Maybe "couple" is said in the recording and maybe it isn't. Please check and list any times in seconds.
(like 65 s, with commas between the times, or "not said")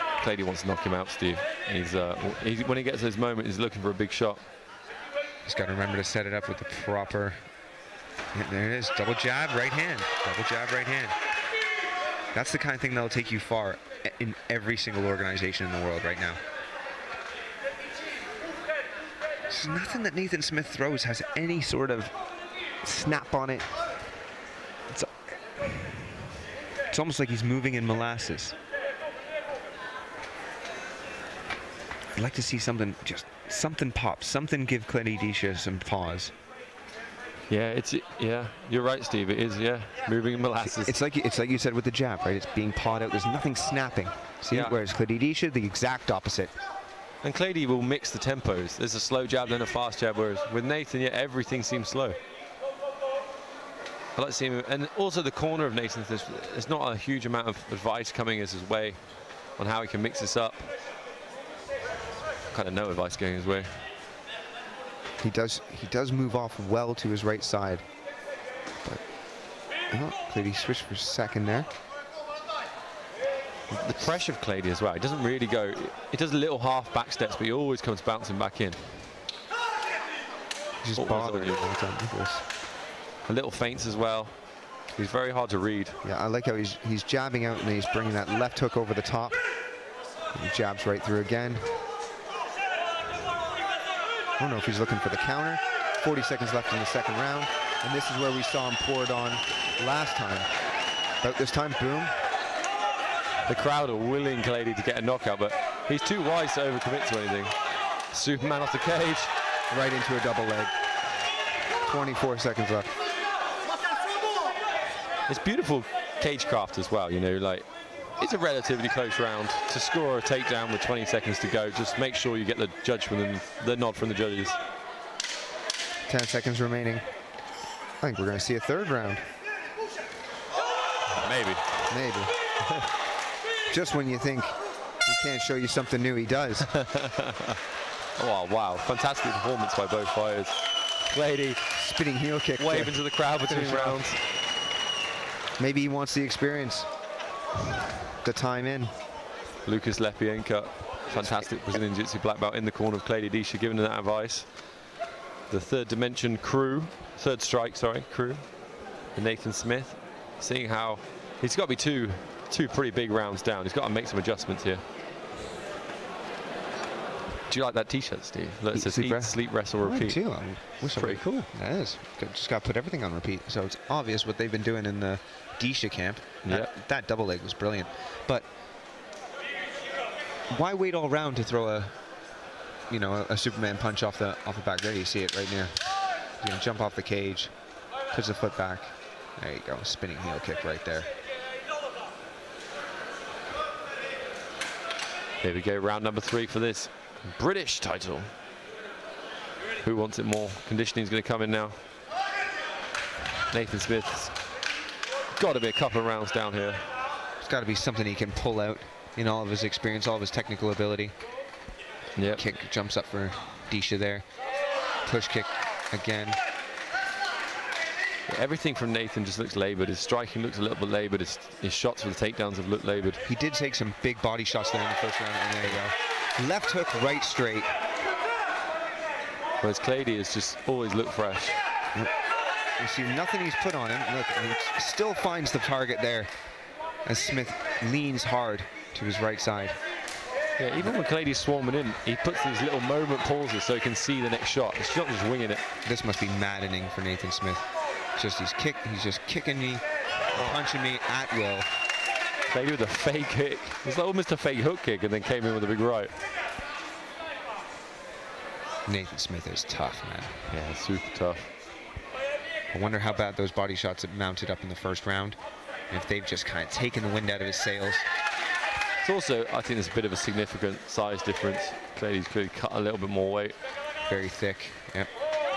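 205 s.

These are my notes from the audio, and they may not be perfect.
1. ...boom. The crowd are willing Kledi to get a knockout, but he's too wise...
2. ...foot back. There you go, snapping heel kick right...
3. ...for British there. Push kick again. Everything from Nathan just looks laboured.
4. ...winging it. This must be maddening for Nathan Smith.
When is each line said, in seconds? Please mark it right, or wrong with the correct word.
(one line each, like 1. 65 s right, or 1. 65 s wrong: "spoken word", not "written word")
1. 101 s right
2. 188 s wrong: "spinning", not "snapping"
3. 213 s wrong: "Disha", not "British"
4. 245 s right.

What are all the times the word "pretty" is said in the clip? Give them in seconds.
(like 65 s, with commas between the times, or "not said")
162 s, 170 s.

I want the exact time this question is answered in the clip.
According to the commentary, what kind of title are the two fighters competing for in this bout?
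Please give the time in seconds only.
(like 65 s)
197 s.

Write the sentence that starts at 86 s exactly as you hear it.
Yeah, I like how he's he's jabbing out and he's bringing that left hook over the top.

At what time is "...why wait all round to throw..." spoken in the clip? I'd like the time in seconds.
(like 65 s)
180 s.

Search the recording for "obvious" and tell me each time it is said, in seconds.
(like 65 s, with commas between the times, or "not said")
173 s.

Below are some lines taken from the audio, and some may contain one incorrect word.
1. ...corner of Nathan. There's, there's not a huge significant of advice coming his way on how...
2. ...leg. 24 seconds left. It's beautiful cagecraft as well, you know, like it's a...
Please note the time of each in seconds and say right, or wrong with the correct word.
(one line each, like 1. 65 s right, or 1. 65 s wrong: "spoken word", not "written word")
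1. 55 s wrong: "amount", not "significant"
2. 110 s right.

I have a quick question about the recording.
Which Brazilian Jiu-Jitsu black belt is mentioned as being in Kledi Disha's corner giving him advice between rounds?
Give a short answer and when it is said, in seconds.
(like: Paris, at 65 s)
Lucas Lepienka, at 149 s.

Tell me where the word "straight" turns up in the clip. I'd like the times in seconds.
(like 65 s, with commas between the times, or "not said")
227 s.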